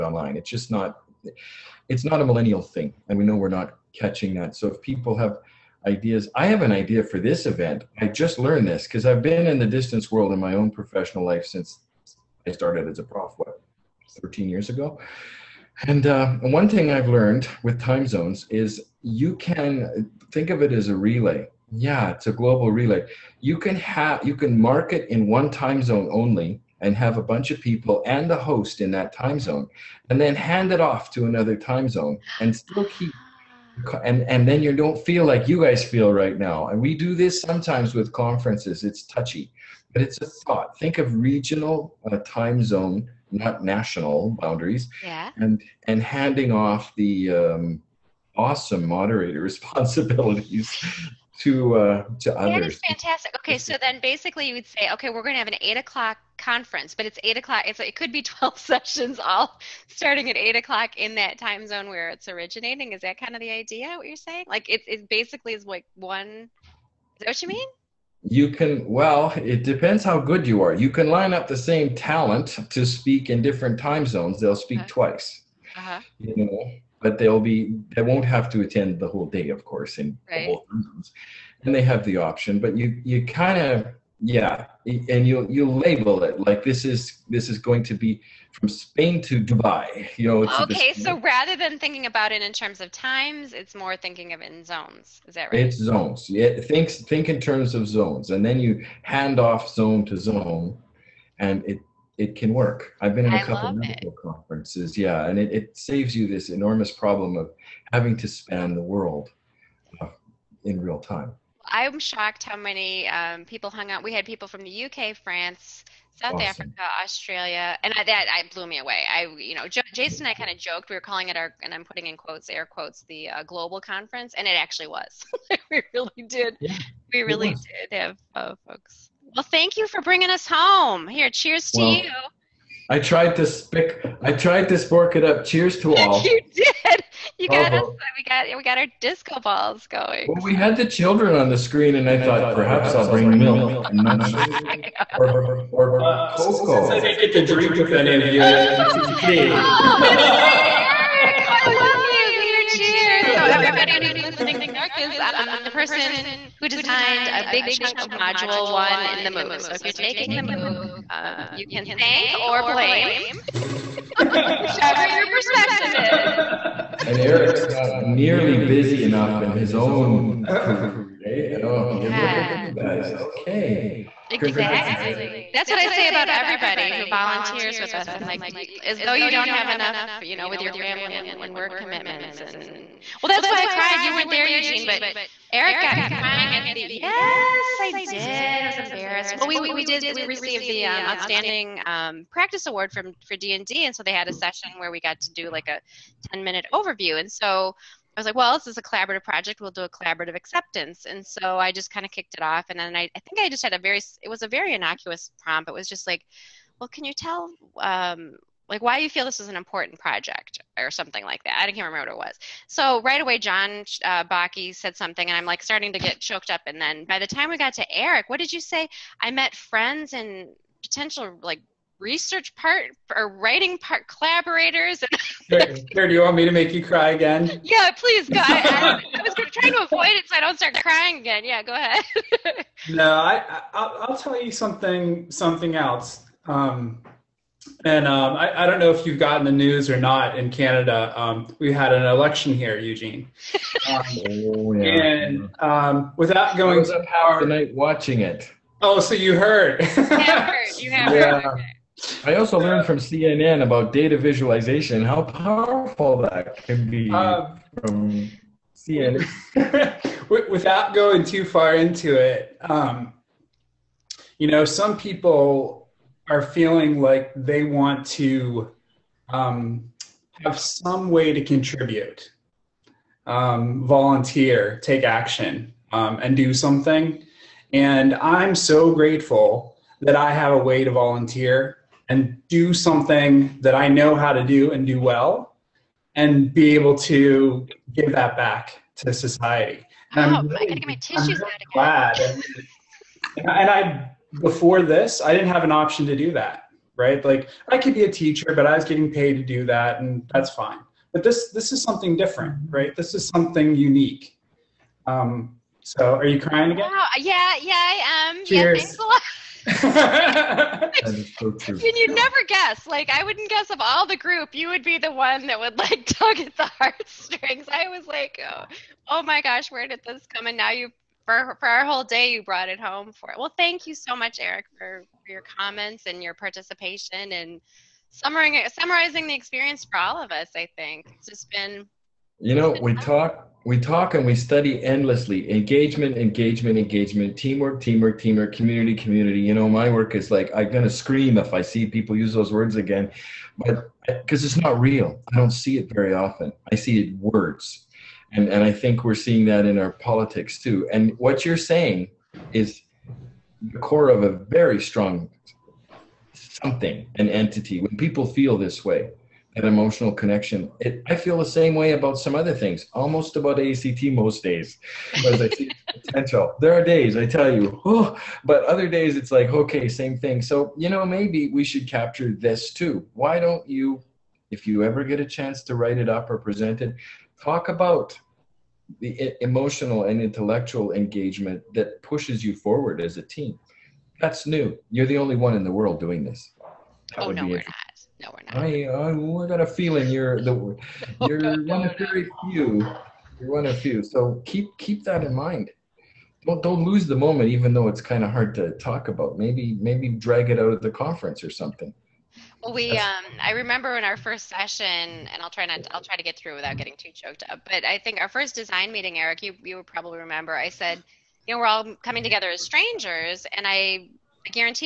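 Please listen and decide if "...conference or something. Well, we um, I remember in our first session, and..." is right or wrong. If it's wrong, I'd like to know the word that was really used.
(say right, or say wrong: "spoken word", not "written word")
right.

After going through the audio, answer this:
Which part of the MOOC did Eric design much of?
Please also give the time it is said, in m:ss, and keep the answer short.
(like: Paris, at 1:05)
module one, at 2:38.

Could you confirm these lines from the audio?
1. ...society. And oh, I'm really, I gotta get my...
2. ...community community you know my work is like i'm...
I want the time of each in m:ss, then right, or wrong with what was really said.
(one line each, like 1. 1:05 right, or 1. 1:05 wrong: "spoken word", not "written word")
1. 4:49 right
2. 5:38 right.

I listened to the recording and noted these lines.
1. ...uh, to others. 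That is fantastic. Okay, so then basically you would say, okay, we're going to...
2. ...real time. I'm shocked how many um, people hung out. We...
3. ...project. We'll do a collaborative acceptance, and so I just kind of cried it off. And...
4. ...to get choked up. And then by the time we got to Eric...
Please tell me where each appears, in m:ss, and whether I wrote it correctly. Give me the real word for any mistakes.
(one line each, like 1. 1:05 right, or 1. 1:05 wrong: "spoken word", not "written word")
1. 0:51 right
2. 1:50 right
3. 3:19 wrong: "kicked", not "cried"
4. 3:35 right.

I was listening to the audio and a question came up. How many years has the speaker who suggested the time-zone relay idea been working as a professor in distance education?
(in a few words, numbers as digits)
13 years.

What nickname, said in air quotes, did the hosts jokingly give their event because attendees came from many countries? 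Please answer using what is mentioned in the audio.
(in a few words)
global conference.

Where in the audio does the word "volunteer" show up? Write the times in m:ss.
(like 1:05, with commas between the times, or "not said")
2:57, 4:33, 4:40.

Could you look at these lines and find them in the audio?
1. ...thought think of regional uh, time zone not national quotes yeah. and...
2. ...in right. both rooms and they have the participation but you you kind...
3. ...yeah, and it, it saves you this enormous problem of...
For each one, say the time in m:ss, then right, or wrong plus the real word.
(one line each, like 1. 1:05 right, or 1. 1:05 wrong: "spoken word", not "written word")
1. 0:40 wrong: "boundaries", not "quotes"
2. 1:19 wrong: "option", not "participation"
3. 1:44 right.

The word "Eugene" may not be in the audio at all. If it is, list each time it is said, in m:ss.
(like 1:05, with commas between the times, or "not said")
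3:04, 4:02.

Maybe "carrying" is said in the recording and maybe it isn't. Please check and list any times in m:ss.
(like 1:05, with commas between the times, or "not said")
not said.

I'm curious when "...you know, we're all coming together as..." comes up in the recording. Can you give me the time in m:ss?
6:51.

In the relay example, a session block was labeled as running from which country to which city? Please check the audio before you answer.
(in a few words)
Spain to Dubai.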